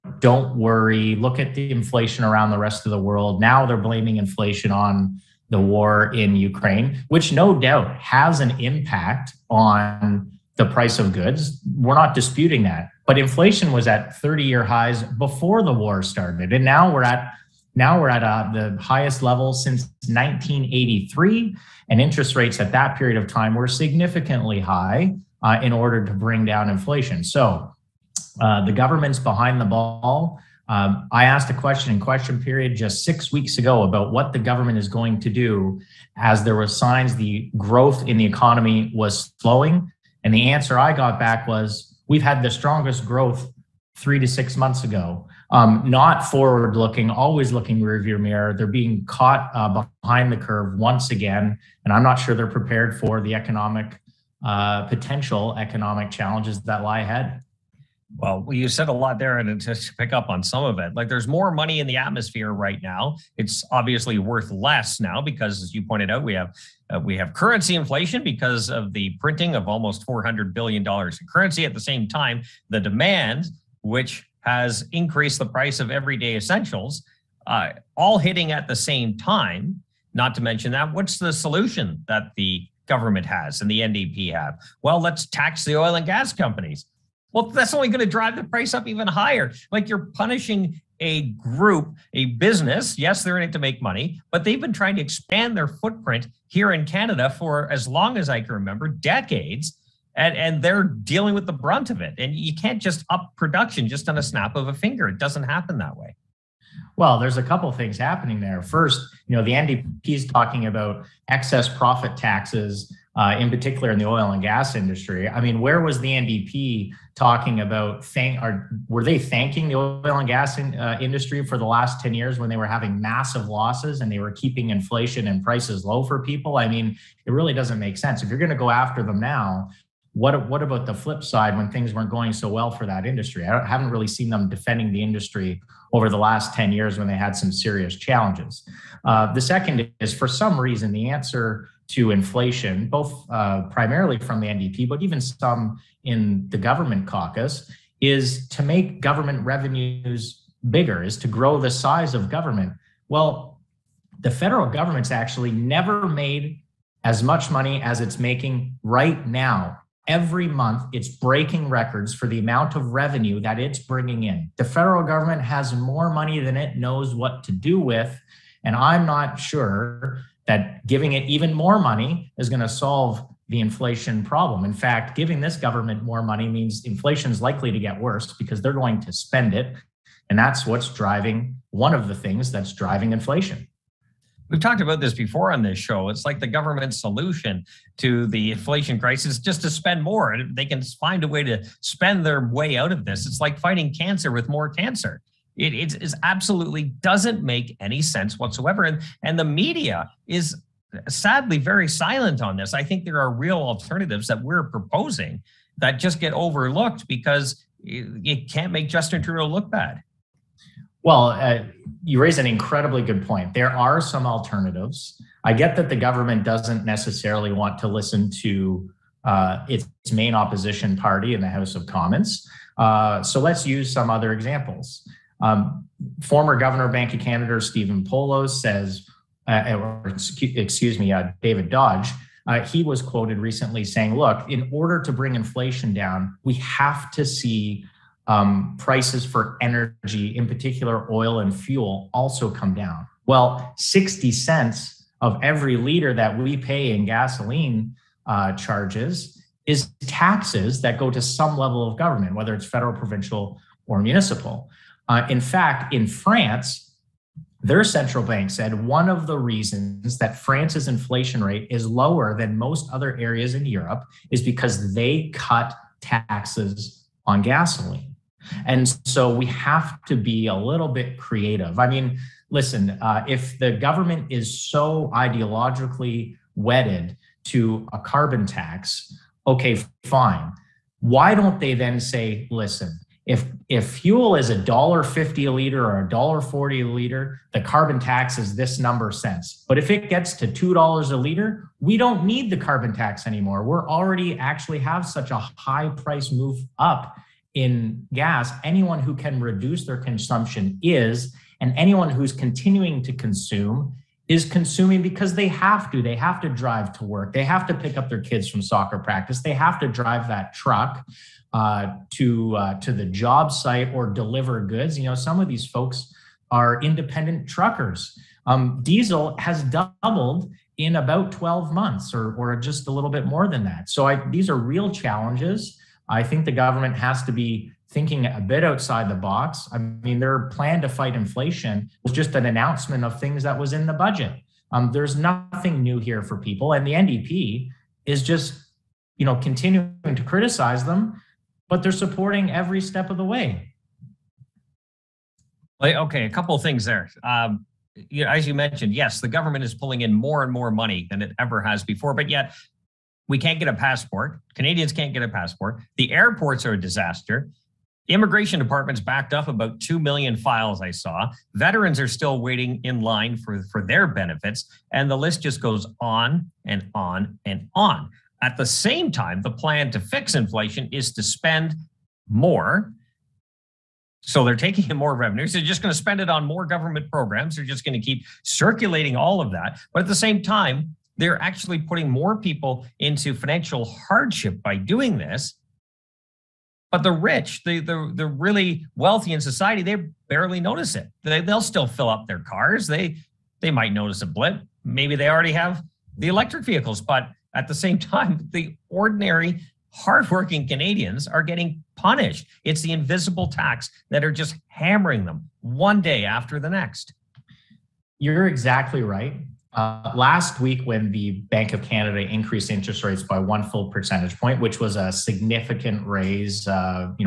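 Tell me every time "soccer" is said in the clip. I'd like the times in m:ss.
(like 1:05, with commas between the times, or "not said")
5:08.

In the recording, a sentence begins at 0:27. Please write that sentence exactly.
So uh, the government's behind the ball.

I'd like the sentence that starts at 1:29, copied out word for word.
Like you're punishing a group, a business.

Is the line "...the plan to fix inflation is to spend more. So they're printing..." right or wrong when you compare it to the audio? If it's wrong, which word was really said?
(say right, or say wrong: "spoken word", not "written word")
wrong: "taking", not "printing".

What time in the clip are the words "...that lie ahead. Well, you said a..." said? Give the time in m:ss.
0:56.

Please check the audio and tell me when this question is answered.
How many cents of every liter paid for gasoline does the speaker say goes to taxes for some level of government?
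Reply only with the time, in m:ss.
4:03.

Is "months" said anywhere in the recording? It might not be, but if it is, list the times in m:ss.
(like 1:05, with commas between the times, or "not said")
0:44, 2:40, 5:21.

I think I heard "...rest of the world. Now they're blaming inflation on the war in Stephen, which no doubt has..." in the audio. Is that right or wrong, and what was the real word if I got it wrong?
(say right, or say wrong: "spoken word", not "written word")
wrong: "Ukraine", not "Stephen".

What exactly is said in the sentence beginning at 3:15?
It, absolutely doesn't make any sense whatsoever.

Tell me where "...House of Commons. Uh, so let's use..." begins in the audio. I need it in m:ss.
3:41.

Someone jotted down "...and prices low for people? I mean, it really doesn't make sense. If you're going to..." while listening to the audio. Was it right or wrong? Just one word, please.
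right.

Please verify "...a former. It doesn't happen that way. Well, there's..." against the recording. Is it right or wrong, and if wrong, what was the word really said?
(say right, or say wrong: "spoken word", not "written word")
wrong: "finger", not "former".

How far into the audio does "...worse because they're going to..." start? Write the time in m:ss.
2:57.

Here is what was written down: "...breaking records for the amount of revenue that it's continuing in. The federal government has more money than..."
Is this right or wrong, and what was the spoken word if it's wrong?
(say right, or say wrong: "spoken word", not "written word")
wrong: "bringing", not "continuing".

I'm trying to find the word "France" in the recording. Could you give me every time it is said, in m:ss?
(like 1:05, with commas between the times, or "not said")
4:16, 4:20.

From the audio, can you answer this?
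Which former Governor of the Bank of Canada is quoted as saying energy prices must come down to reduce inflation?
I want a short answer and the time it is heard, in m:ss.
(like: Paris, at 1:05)
David Dodge, at 3:51.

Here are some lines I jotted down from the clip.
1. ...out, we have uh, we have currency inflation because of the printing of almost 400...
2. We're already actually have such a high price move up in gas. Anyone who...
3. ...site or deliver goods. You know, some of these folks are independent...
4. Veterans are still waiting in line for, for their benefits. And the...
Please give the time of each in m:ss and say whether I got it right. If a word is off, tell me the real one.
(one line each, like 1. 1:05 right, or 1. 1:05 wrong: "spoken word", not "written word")
1. 1:06 right
2. 4:53 right
3. 5:13 right
4. 6:01 right.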